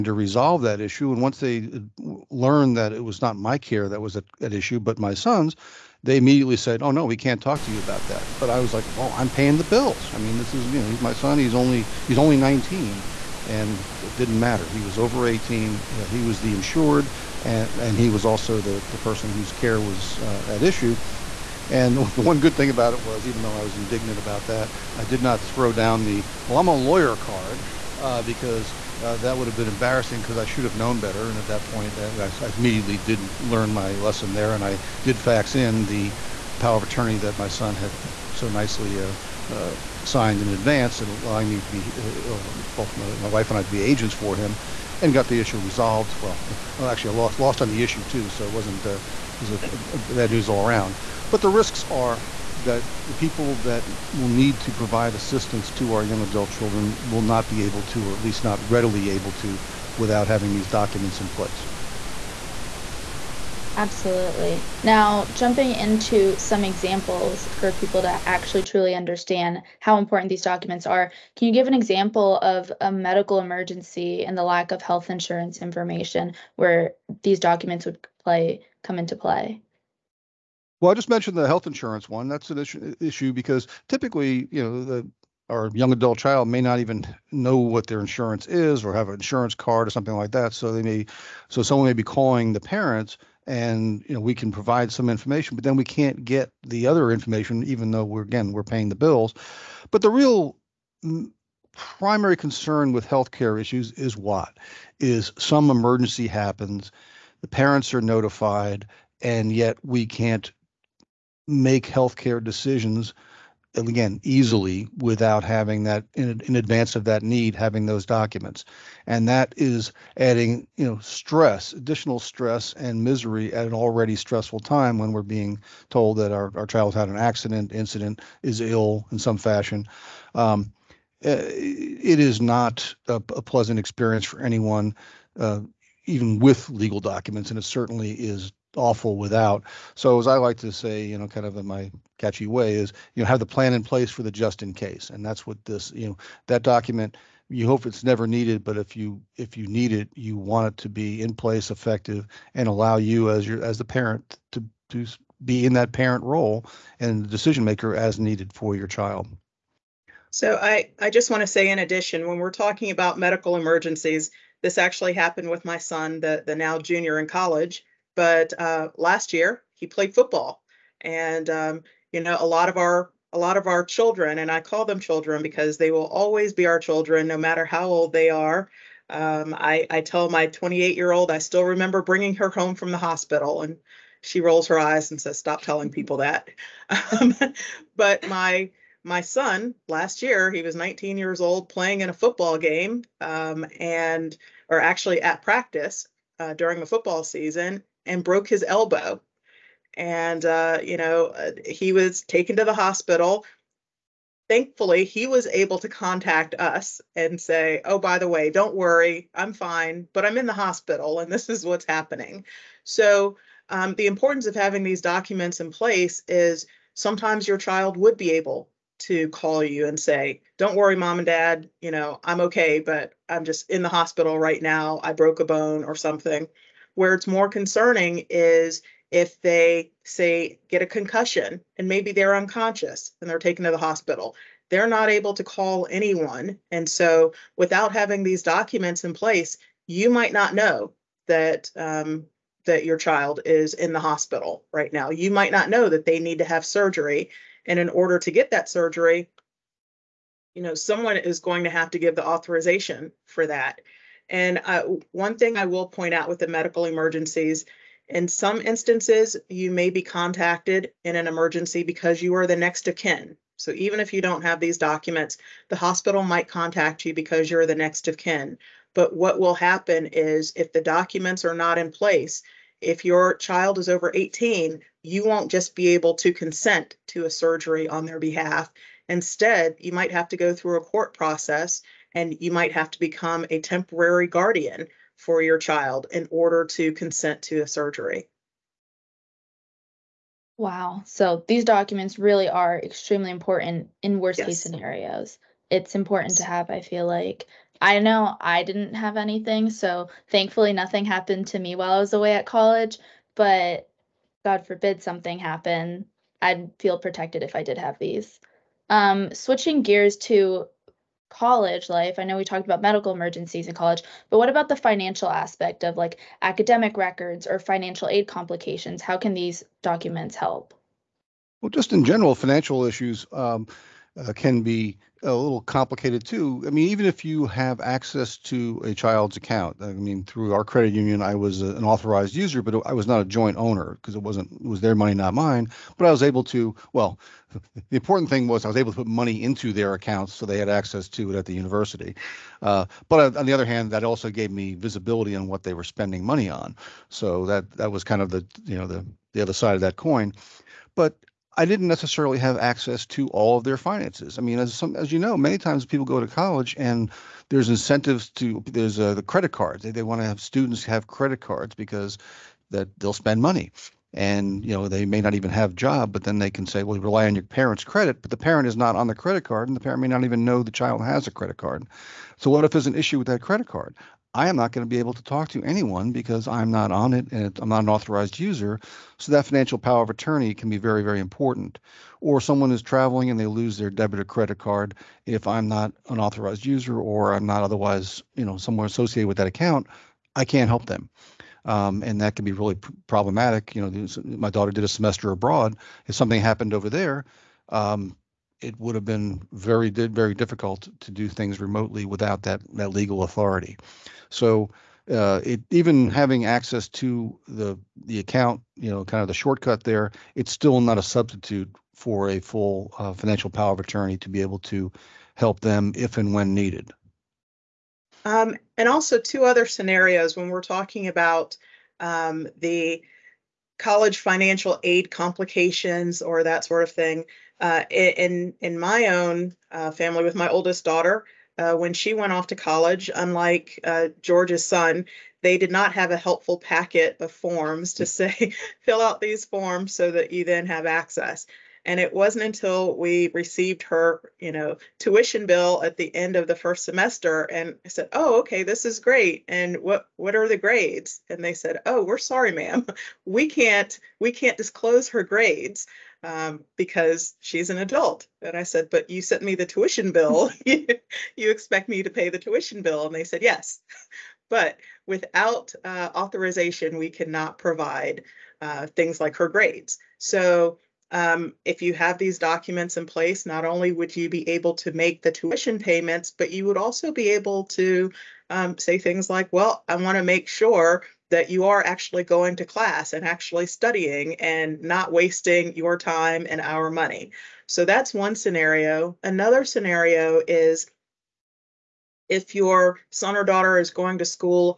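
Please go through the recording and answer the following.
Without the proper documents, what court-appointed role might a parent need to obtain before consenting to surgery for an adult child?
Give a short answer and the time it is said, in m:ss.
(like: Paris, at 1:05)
Temporary guardian, at 4:43.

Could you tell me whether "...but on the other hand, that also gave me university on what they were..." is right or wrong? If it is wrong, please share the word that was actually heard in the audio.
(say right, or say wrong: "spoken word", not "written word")
wrong: "visibility", not "university".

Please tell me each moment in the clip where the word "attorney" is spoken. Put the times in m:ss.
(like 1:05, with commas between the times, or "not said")
0:36, 6:20, 6:53.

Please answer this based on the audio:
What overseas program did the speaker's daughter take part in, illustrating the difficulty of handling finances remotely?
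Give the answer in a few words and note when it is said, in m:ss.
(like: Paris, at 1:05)
Semester abroad, at 6:34.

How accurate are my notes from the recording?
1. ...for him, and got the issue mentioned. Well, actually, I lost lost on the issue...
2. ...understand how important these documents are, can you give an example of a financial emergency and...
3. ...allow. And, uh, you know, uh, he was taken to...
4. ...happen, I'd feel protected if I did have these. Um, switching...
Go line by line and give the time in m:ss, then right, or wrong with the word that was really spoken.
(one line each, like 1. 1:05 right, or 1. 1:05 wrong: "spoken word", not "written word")
1. 0:44 wrong: "resolved", not "mentioned"
2. 1:08 wrong: "medical", not "financial"
3. 3:18 wrong: "elbow", not "allow"
4. 5:05 right.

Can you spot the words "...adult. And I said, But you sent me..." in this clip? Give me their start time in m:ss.
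7:37.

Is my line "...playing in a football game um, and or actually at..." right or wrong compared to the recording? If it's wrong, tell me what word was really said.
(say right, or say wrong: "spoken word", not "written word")
right.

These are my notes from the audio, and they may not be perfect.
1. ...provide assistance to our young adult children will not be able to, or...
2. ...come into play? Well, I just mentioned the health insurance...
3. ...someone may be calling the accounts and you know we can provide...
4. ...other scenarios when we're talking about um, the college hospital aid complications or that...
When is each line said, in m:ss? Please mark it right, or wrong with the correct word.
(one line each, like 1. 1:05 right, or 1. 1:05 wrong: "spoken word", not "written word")
1. 0:54 right
2. 1:18 right
3. 1:31 wrong: "parents", not "accounts"
4. 6:59 wrong: "financial", not "hospital".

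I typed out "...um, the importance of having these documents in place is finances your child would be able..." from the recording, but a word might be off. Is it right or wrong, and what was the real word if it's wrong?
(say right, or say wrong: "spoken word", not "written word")
wrong: "sometimes", not "finances".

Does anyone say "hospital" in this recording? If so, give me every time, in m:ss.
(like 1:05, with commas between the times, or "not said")
3:02, 3:22, 3:30, 3:43, 3:53, 4:03, 4:25.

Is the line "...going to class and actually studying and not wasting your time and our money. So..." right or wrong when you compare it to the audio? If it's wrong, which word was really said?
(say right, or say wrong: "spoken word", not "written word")
right.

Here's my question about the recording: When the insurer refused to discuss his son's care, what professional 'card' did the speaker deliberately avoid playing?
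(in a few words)
I'm a lawyer.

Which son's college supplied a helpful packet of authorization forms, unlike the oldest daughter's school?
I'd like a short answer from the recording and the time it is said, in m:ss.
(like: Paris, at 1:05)
George, at 7:14.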